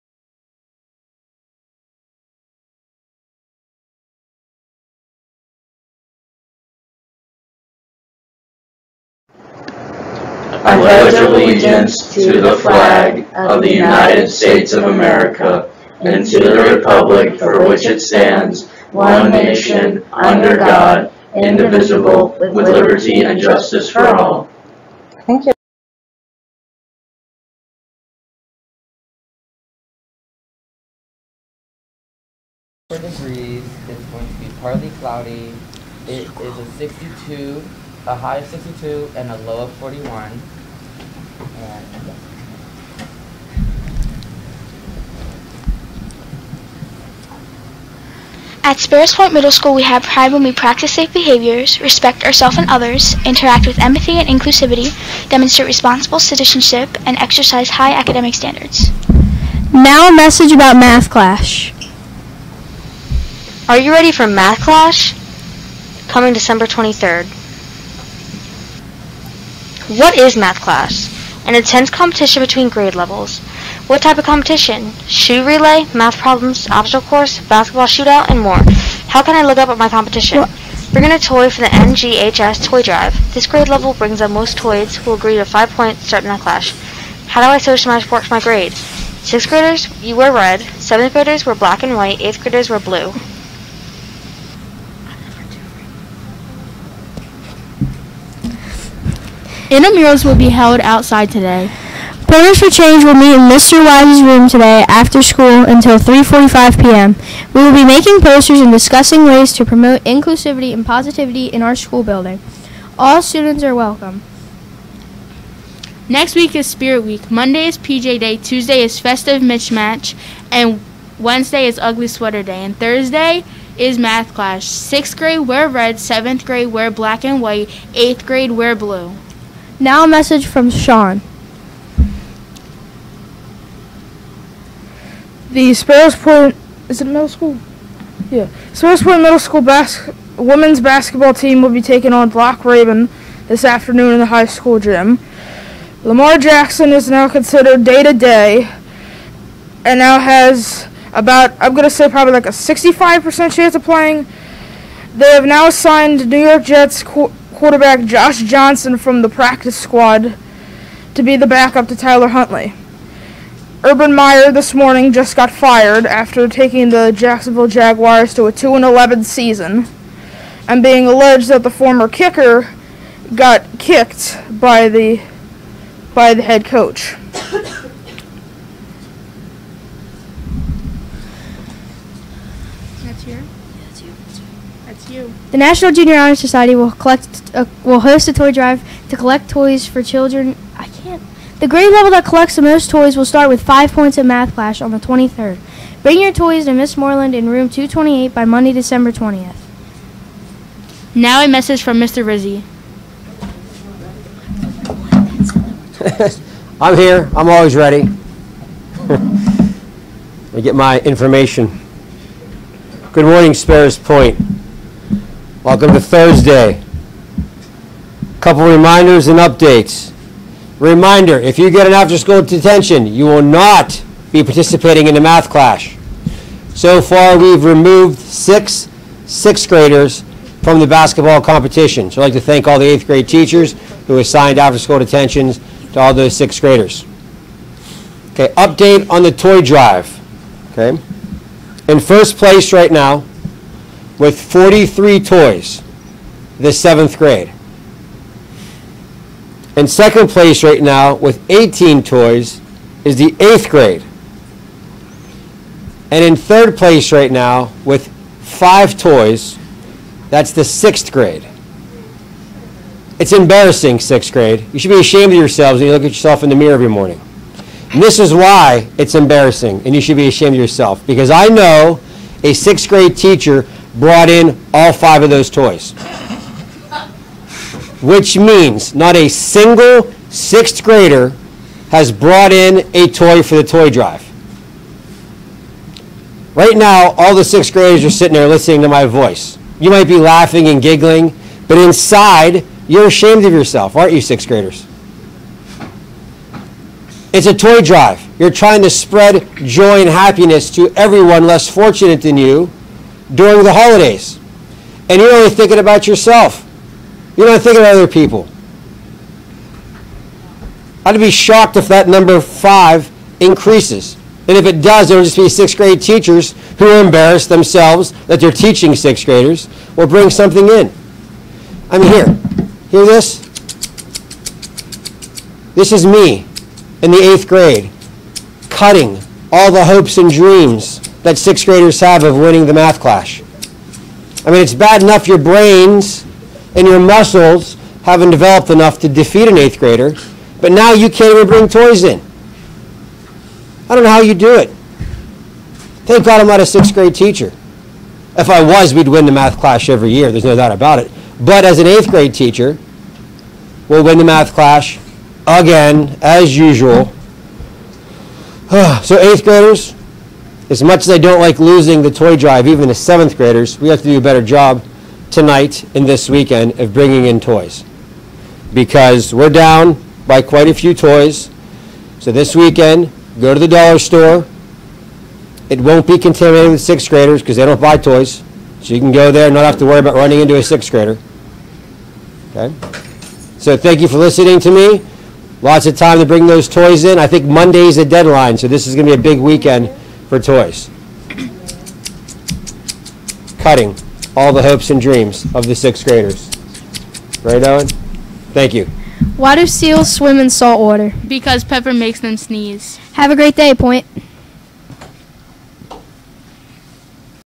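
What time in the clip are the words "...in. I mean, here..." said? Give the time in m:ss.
5:20.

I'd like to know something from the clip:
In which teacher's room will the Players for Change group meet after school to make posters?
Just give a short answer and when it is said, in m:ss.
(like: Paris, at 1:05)
Mr. Wise's room, at 1:43.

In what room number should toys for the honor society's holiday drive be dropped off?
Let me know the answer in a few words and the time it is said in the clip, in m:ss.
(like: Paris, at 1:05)
228, at 3:17.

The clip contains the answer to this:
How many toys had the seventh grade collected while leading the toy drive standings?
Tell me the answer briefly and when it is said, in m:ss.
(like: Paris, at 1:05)
43, at 4:04.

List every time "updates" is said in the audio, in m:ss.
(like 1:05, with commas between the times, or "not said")
3:39, 3:58.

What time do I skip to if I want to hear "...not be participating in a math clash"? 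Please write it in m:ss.
3:43.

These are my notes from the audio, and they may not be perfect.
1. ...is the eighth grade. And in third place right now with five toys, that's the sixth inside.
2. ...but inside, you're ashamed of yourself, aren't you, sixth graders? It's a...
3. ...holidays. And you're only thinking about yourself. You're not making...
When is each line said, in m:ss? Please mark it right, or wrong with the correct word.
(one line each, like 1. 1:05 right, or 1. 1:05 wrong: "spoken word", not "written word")
1. 4:13 wrong: "grade", not "inside"
2. 4:51 right
3. 5:03 wrong: "thinking", not "making".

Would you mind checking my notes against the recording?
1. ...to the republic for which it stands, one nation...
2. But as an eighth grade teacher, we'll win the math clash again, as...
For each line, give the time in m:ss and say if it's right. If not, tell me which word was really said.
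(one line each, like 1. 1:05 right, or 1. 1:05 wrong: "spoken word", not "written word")
1. 0:16 right
2. 5:51 right.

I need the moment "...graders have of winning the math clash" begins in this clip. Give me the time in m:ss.
5:31.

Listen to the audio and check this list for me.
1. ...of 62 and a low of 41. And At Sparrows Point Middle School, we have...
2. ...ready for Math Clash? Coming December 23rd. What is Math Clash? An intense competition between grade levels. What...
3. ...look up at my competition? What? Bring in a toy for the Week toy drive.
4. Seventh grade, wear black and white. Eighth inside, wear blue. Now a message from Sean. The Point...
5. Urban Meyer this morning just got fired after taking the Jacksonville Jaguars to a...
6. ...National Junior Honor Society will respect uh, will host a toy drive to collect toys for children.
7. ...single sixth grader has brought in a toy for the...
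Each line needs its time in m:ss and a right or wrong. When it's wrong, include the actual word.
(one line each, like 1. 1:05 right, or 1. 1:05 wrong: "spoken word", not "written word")
1. 0:38 right
2. 1:03 right
3. 1:19 wrong: "NJHS", not "Week"
4. 2:05 wrong: "grade", not "inside"
5. 2:43 right
6. 3:05 wrong: "collect", not "respect"
7. 4:39 right.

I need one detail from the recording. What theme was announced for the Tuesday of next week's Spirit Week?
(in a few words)
Festive Mismatch.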